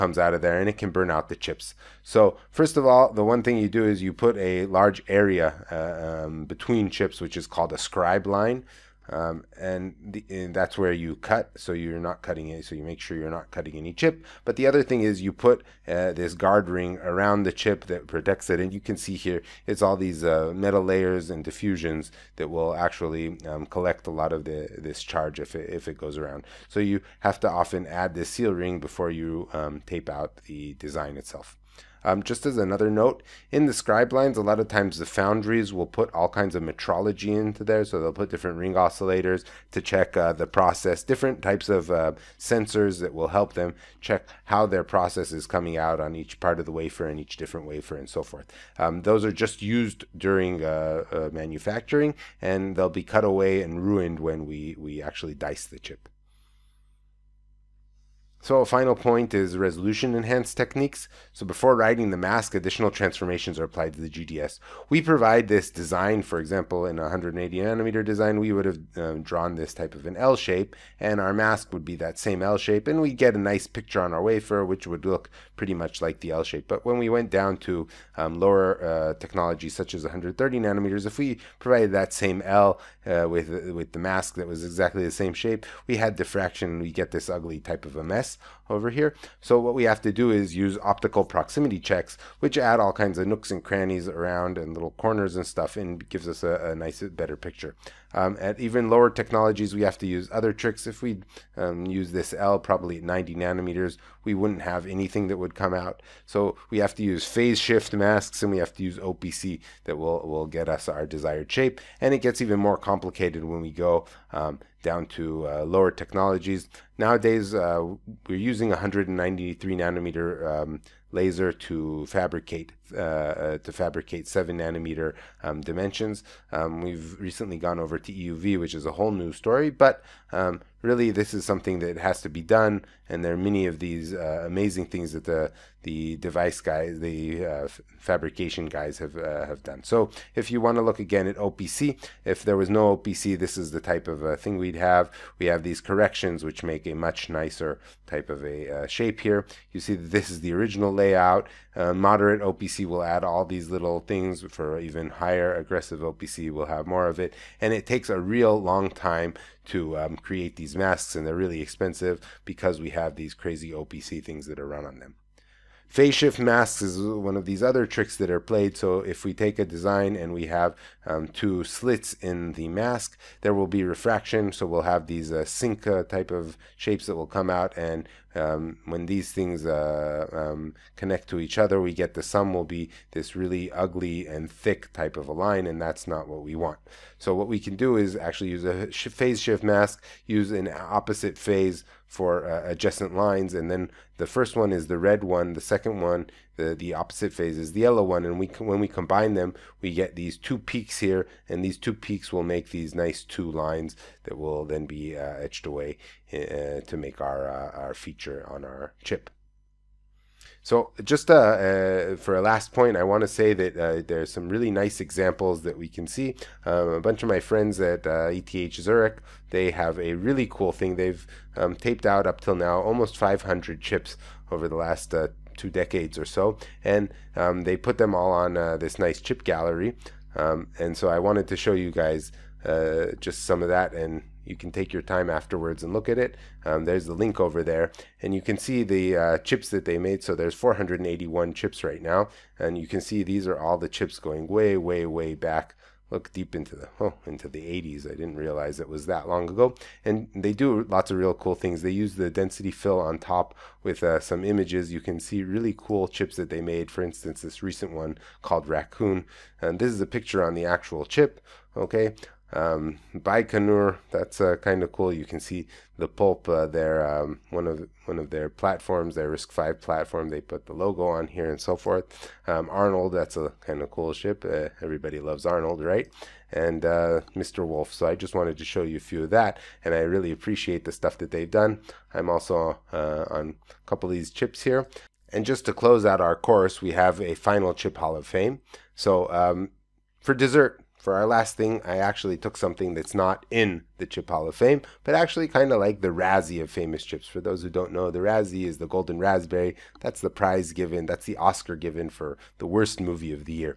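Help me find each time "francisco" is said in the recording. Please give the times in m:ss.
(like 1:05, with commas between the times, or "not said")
not said.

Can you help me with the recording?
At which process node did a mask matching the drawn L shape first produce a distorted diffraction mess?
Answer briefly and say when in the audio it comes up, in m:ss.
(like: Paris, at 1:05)
130 nanometers, at 1:20.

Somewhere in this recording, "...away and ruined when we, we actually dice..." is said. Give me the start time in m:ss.
0:53.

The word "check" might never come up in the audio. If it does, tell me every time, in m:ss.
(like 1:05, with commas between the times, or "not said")
0:39, 0:44, 1:31.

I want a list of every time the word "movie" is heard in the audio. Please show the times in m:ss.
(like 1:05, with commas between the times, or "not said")
5:03.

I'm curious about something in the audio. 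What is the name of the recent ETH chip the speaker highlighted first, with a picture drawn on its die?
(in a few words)
Raccoon.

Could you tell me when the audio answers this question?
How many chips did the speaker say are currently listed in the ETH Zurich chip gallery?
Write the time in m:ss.
4:00.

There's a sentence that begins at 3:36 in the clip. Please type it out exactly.
Um, a bunch of my friends at ETH uh, Zurich, they have a really cool thing.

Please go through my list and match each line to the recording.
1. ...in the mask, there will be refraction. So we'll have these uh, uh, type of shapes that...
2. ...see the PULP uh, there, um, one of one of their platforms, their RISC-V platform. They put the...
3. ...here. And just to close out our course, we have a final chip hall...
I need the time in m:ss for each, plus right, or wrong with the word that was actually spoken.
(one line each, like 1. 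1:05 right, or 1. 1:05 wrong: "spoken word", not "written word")
1. 2:52 right
2. 4:25 right
3. 4:44 right.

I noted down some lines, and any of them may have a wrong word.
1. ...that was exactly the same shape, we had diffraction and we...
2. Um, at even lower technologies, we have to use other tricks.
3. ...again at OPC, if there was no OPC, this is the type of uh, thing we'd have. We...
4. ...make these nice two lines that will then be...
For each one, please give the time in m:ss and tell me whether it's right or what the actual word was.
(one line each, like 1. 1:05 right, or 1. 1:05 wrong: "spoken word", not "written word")
1. 1:24 right
2. 1:38 right
3. 2:20 right
4. 3:22 right.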